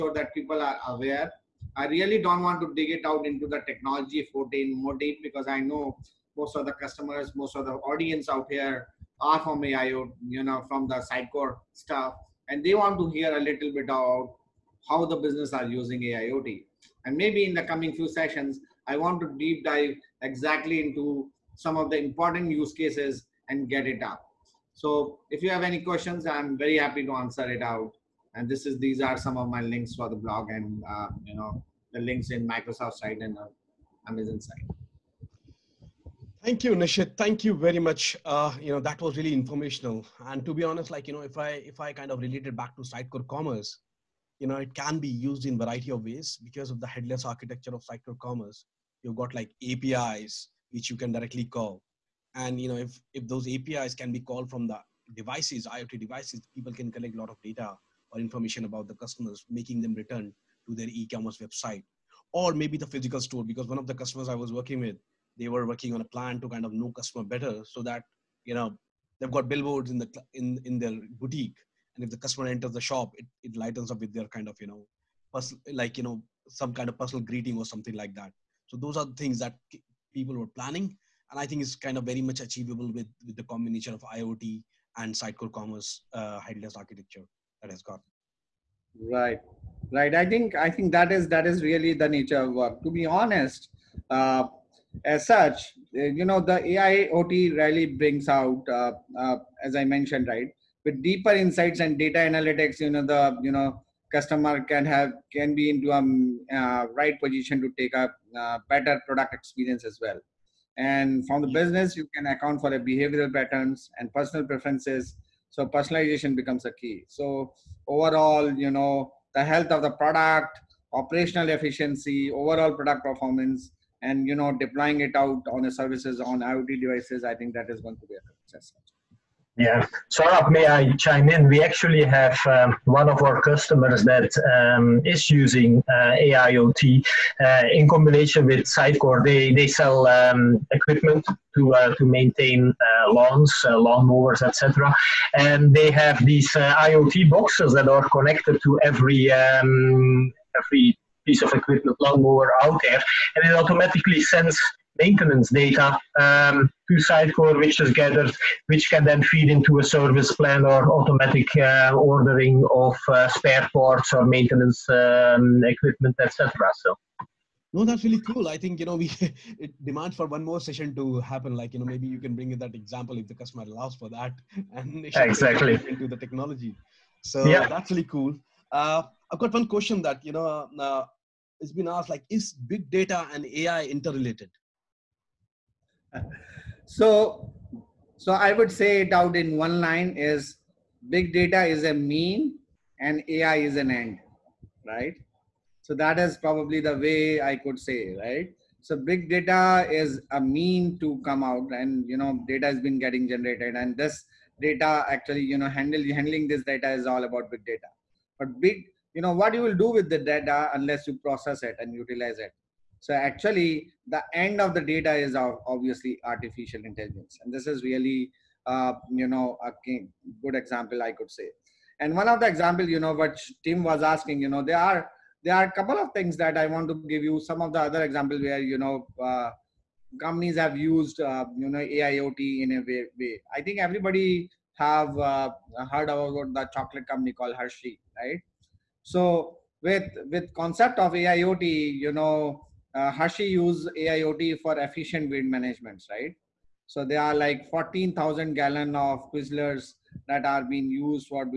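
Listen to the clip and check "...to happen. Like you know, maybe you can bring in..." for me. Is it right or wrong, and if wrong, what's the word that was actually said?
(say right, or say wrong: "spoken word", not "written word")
right.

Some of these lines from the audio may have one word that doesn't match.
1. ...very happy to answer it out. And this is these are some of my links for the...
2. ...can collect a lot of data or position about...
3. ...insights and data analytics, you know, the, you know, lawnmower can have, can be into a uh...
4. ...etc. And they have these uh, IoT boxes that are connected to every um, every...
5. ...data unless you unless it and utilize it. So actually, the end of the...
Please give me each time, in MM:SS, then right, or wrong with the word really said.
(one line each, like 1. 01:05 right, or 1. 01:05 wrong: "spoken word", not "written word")
1. 00:26 right
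2. 00:56 wrong: "information", not "position"
3. 01:41 wrong: "customer", not "lawnmower"
4. 02:24 right
5. 03:30 wrong: "process", not "unless".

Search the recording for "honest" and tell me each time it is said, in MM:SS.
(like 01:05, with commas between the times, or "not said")
00:40, 01:33.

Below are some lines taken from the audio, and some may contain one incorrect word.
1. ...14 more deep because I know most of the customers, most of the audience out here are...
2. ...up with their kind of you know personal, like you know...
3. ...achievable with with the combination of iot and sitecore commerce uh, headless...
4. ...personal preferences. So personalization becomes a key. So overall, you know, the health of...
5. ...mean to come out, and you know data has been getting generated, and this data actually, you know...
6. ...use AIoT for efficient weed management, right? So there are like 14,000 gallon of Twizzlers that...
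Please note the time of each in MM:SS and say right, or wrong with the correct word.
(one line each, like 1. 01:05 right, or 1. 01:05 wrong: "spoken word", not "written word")
1. 00:04 right
2. 01:13 right
3. 01:22 right
4. 01:54 right
5. 03:20 right
6. 04:03 right.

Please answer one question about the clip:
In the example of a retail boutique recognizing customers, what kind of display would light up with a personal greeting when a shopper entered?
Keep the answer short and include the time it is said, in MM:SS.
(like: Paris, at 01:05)
billboards, at 01:09.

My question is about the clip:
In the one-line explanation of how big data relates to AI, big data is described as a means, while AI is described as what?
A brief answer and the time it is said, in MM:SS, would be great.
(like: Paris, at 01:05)
an end, at 03:13.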